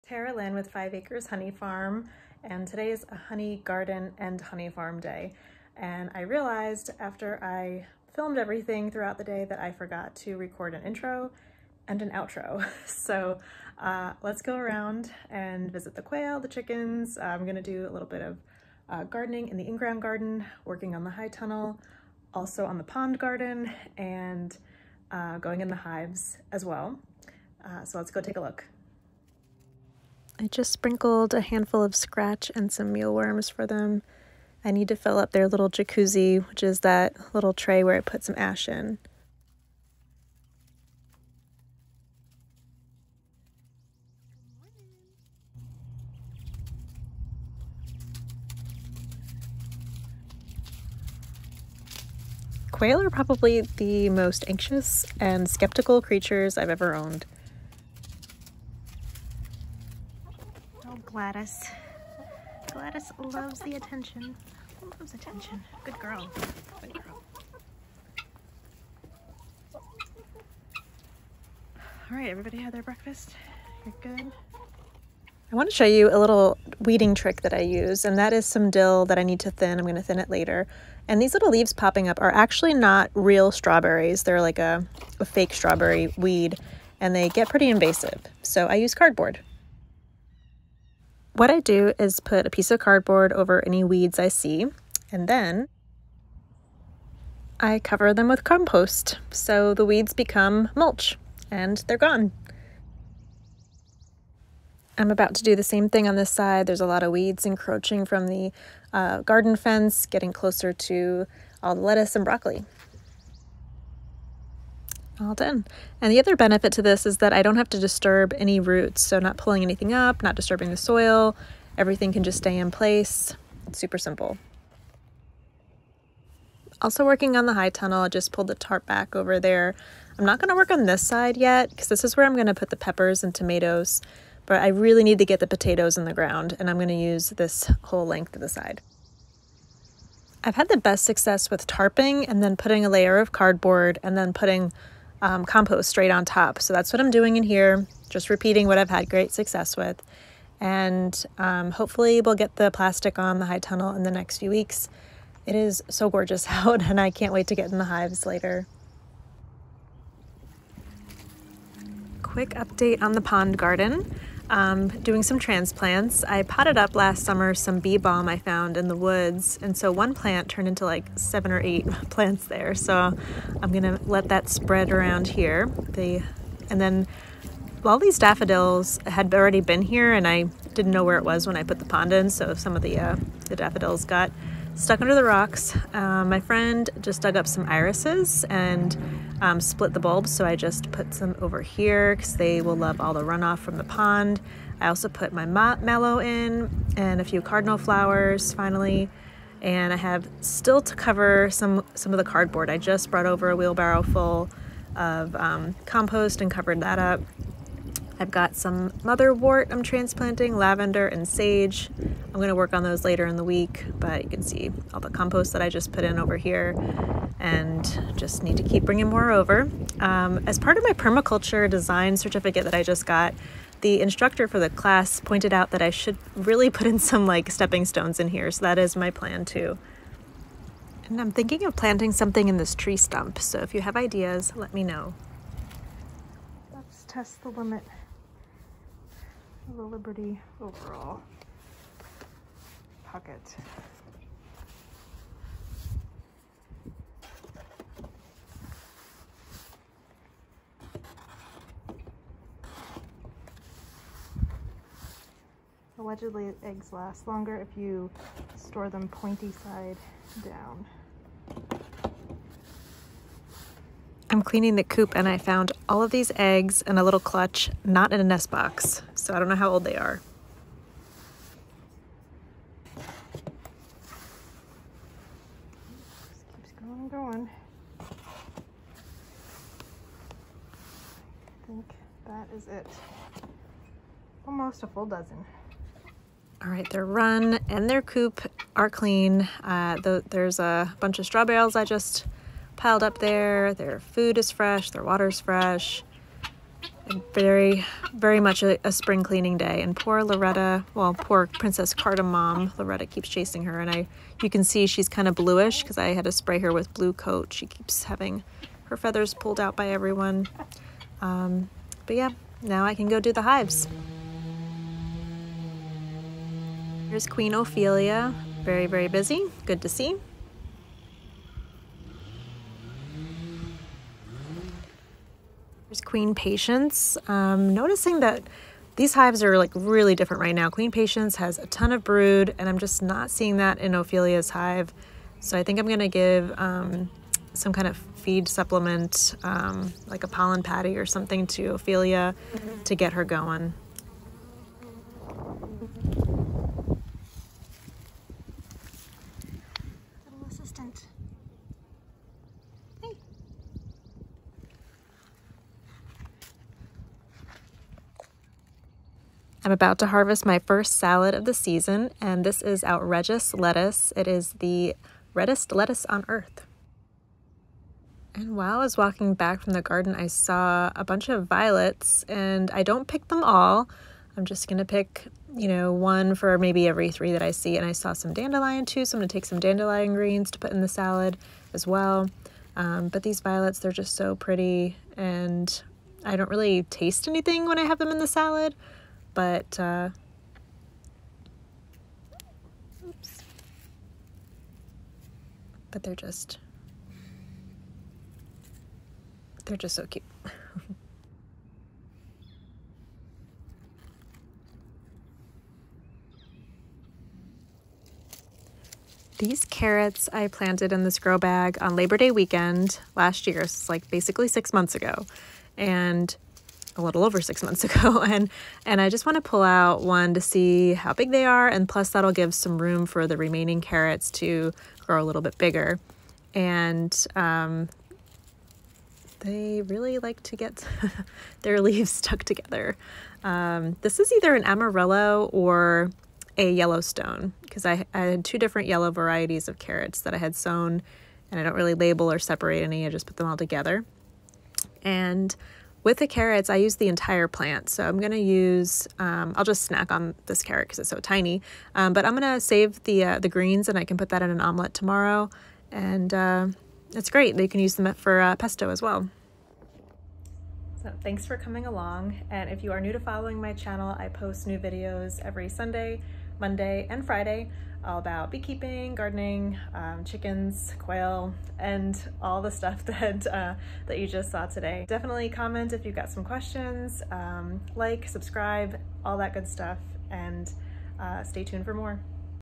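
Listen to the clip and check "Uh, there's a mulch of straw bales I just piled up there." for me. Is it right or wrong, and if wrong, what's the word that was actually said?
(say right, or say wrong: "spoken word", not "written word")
wrong: "bunch", not "mulch".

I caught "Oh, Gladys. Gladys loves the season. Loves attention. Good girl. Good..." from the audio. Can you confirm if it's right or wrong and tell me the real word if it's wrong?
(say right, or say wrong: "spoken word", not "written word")
wrong: "attention", not "season".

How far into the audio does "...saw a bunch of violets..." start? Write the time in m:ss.
6:10.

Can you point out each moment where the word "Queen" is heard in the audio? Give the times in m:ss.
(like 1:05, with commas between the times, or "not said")
5:17, 5:26, 5:30.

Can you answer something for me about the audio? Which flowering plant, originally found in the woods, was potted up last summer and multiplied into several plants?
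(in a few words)
bee balm.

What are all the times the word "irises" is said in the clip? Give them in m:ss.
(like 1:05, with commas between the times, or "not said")
3:07.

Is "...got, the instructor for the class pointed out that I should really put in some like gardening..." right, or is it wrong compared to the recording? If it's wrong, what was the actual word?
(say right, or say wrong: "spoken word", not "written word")
wrong: "stepping", not "gardening".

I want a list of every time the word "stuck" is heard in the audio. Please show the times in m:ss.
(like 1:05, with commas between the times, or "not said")
3:04, 7:12.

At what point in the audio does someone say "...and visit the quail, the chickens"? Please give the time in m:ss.
0:15.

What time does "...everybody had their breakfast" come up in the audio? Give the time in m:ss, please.
1:12.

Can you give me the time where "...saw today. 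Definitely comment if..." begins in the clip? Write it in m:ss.
7:54.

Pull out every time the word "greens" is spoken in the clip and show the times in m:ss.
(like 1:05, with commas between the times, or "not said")
6:20, 7:33.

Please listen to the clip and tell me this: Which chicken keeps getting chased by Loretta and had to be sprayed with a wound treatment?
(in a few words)
Princess Cardamom.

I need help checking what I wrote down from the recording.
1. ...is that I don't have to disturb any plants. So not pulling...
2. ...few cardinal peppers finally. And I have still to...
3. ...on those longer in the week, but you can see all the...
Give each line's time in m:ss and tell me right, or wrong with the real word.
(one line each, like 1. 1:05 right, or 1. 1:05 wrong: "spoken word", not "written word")
1. 1:57 wrong: "roots", not "plants"
2. 3:17 wrong: "flowers", not "peppers"
3. 3:32 wrong: "later", not "longer".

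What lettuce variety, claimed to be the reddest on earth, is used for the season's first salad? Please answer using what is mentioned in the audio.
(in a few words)
Outredgeous.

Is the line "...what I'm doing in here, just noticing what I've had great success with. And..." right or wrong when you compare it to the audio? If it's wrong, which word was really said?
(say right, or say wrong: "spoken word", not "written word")
wrong: "repeating", not "noticing".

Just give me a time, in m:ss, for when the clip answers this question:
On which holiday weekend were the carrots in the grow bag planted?
6:51.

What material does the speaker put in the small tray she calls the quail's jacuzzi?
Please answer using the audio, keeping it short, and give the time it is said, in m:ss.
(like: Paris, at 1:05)
ash, at 0:38.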